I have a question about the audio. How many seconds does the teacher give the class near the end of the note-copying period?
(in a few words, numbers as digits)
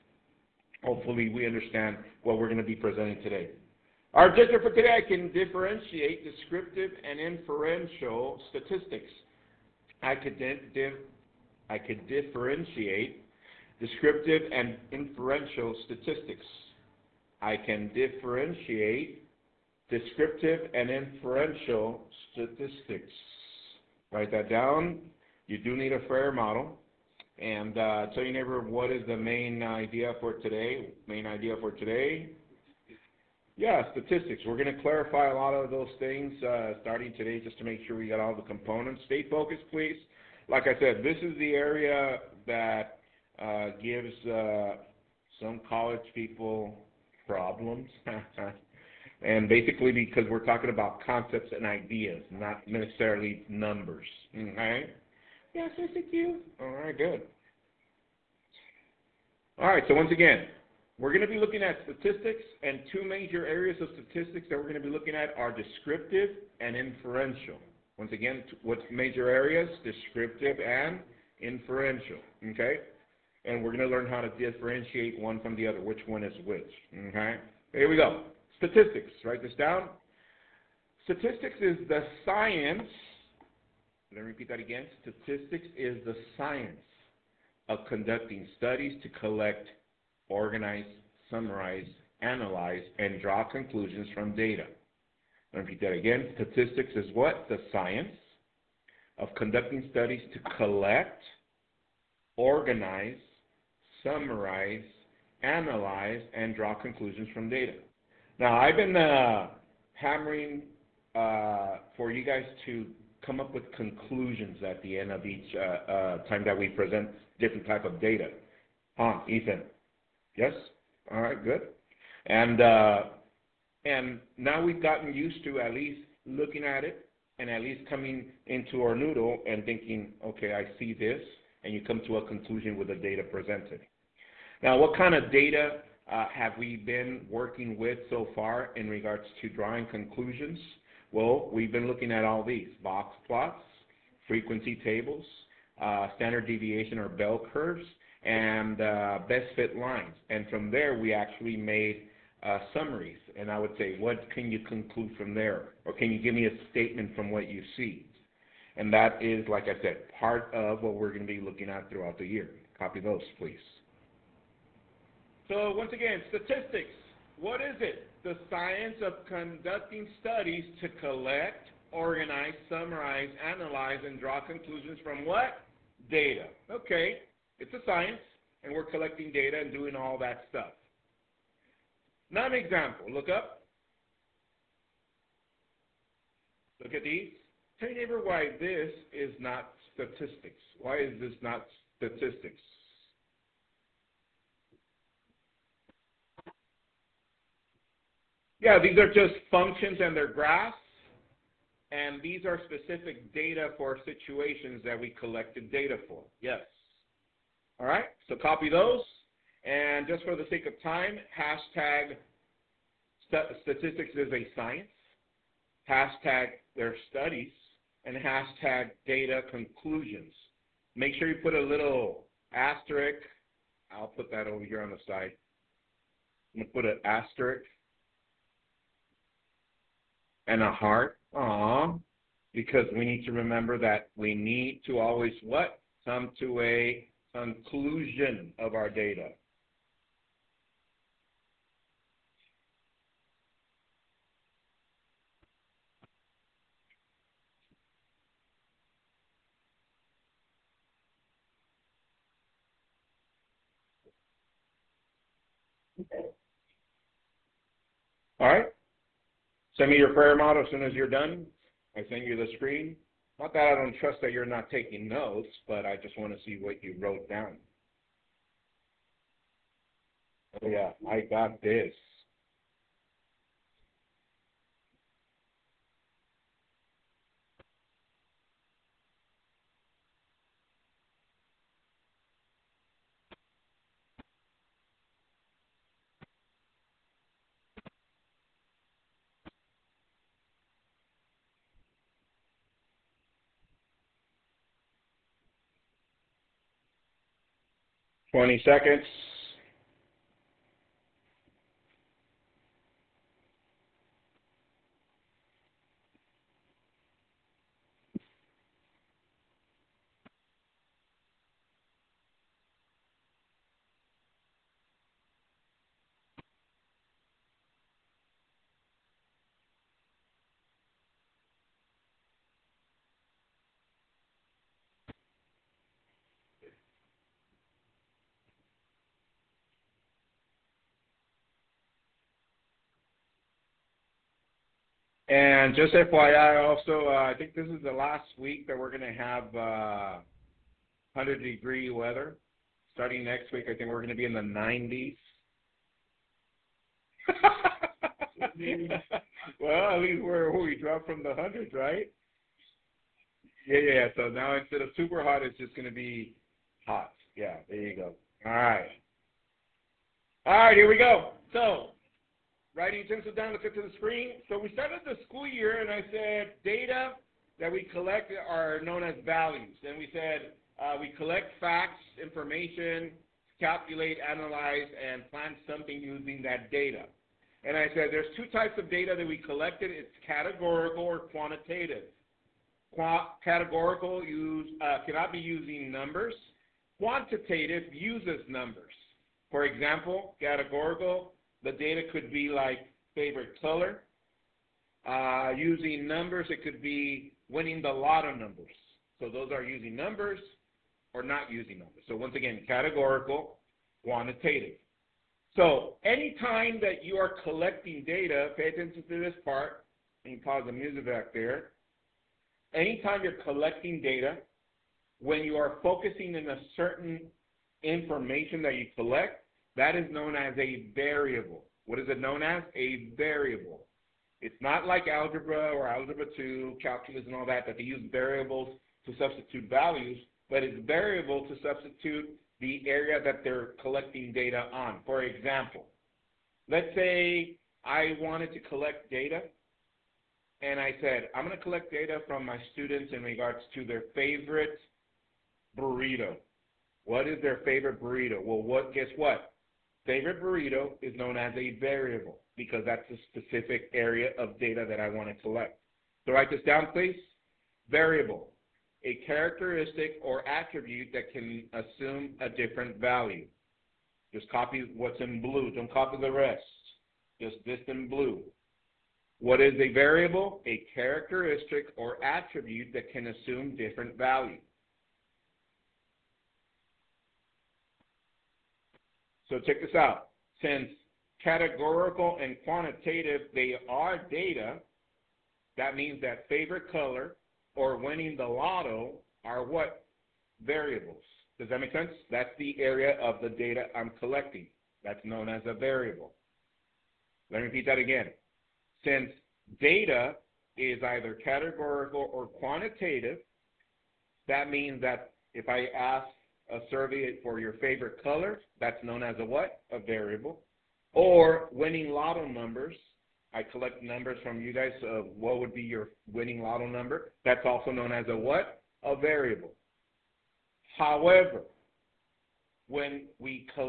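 20.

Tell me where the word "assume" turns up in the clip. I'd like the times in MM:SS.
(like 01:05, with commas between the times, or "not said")
07:41, 07:53.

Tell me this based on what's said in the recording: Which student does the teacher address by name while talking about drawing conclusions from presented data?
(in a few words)
Ethan.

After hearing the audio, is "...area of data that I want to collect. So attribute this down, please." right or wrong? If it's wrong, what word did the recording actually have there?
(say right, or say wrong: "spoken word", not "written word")
wrong: "write", not "attribute".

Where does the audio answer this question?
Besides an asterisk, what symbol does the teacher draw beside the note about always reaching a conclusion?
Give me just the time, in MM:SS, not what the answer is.
03:50.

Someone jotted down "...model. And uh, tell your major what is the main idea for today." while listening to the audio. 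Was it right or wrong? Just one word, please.
wrong.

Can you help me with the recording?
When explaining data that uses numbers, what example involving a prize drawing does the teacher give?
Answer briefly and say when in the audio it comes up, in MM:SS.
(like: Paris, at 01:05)
Winning lotto numbers, at 06:37.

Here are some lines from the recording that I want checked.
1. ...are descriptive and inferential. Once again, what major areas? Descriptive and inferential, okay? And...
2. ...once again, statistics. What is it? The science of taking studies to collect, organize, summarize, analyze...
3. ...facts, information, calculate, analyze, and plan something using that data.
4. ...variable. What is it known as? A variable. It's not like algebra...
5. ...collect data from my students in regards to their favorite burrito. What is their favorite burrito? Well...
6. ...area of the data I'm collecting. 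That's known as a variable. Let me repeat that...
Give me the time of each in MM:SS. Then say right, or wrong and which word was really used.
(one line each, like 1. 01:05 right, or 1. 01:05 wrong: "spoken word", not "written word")
1. 01:05 right
2. 02:45 wrong: "conducting", not "taking"
3. 06:11 right
4. 07:00 right
5. 07:21 right
6. 08:12 right.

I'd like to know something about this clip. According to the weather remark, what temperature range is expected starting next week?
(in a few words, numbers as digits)
The 90s.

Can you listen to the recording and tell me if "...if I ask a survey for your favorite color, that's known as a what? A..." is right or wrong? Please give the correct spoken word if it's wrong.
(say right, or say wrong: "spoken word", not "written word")
right.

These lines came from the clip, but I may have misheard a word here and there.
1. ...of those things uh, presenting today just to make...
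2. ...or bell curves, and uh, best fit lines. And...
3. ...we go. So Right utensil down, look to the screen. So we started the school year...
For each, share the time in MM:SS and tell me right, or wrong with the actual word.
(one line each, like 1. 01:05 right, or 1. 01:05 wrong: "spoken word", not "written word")
1. 00:35 wrong: "starting", not "presenting"
2. 02:26 right
3. 06:00 right.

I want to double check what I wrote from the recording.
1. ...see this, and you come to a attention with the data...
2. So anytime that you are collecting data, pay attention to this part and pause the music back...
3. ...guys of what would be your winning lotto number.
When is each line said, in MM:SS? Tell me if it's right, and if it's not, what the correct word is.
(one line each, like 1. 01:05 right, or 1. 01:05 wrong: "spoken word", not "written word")
1. 02:10 wrong: "conclusion", not "attention"
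2. 06:45 right
3. 08:34 right.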